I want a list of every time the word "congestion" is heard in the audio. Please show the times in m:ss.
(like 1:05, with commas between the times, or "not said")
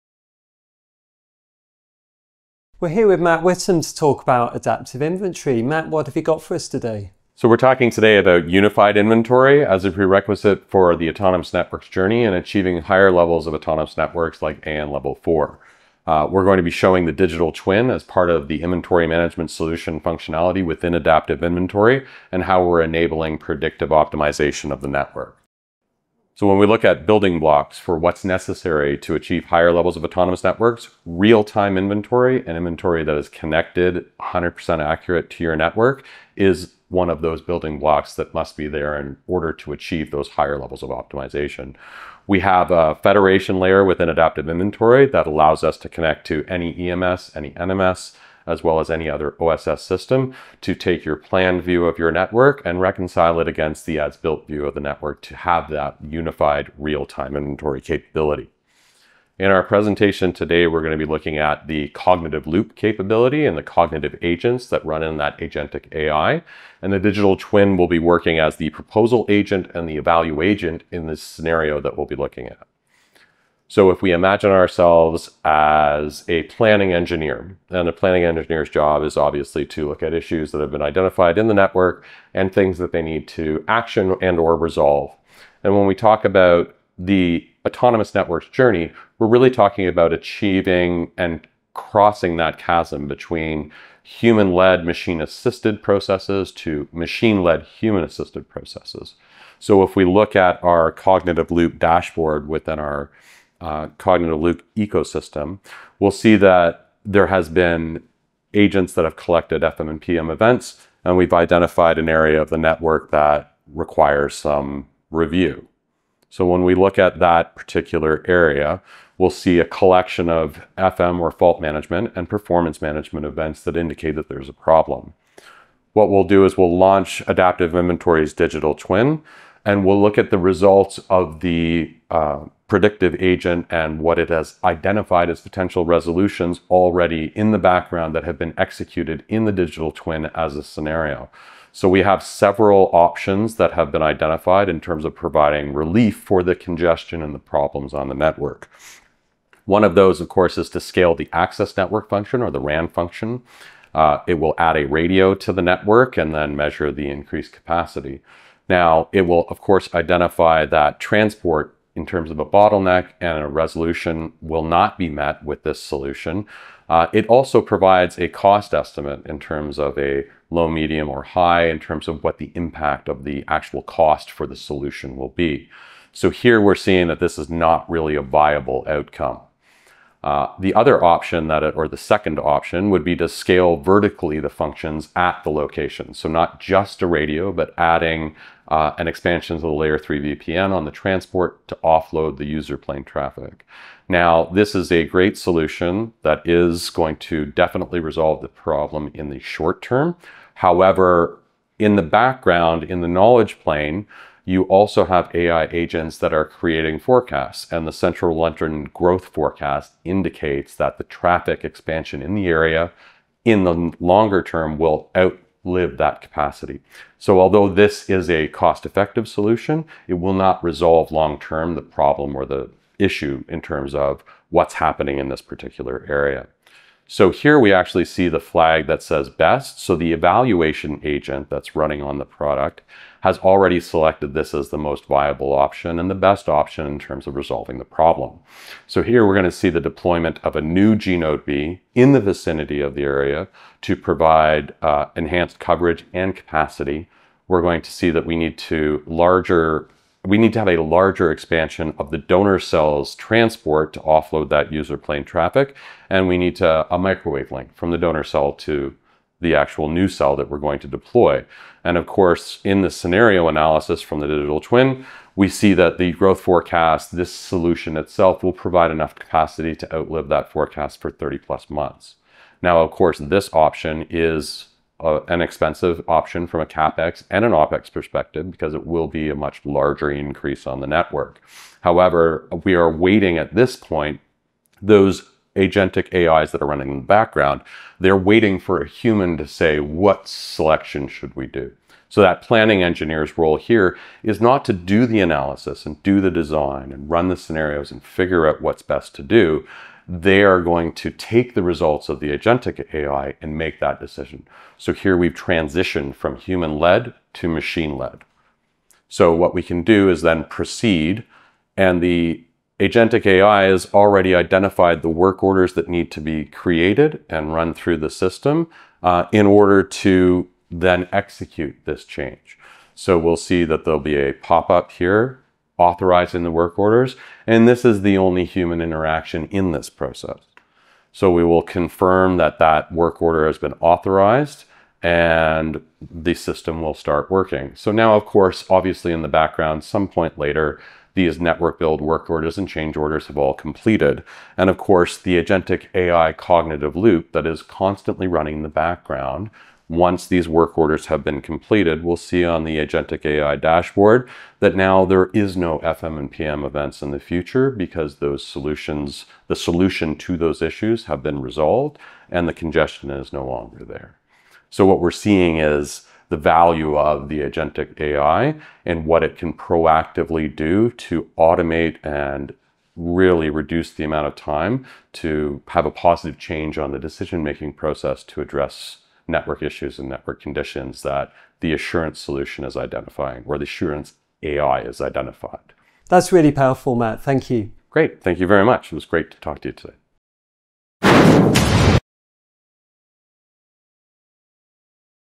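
2:26, 6:02.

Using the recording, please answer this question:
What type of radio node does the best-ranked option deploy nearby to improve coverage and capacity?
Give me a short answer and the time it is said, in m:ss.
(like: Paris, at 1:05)
gNodeB, at 4:00.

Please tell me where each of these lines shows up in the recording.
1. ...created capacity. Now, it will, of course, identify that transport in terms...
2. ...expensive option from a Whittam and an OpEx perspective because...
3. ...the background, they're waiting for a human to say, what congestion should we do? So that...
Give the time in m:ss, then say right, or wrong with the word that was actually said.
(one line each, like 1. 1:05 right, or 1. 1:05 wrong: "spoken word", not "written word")
1. 2:37 wrong: "increased", not "created"
2. 4:35 wrong: "CapEx", not "Whittam"
3. 4:46 wrong: "selection", not "congestion".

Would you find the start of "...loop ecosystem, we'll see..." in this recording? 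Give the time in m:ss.
1:44.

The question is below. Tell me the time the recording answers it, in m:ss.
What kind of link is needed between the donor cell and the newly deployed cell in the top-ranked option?
4:16.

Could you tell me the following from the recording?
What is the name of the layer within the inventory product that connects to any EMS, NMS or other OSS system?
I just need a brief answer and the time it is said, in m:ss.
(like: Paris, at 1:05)
federation layer, at 0:43.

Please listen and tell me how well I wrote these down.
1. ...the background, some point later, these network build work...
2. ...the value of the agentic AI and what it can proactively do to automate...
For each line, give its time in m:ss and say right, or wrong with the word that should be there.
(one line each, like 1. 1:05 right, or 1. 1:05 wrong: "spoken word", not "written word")
1. 5:39 right
2. 6:06 right.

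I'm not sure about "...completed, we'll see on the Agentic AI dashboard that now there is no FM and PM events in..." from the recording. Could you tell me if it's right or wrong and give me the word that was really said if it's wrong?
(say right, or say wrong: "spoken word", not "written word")
right.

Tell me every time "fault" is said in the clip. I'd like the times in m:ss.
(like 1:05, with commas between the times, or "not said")
2:01.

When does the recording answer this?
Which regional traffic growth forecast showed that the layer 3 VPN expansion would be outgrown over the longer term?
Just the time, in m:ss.
3:27.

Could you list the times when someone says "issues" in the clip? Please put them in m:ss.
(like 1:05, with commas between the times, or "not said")
1:20, 3:42, 6:00, 6:19.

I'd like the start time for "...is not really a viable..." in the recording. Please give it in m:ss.
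2:57.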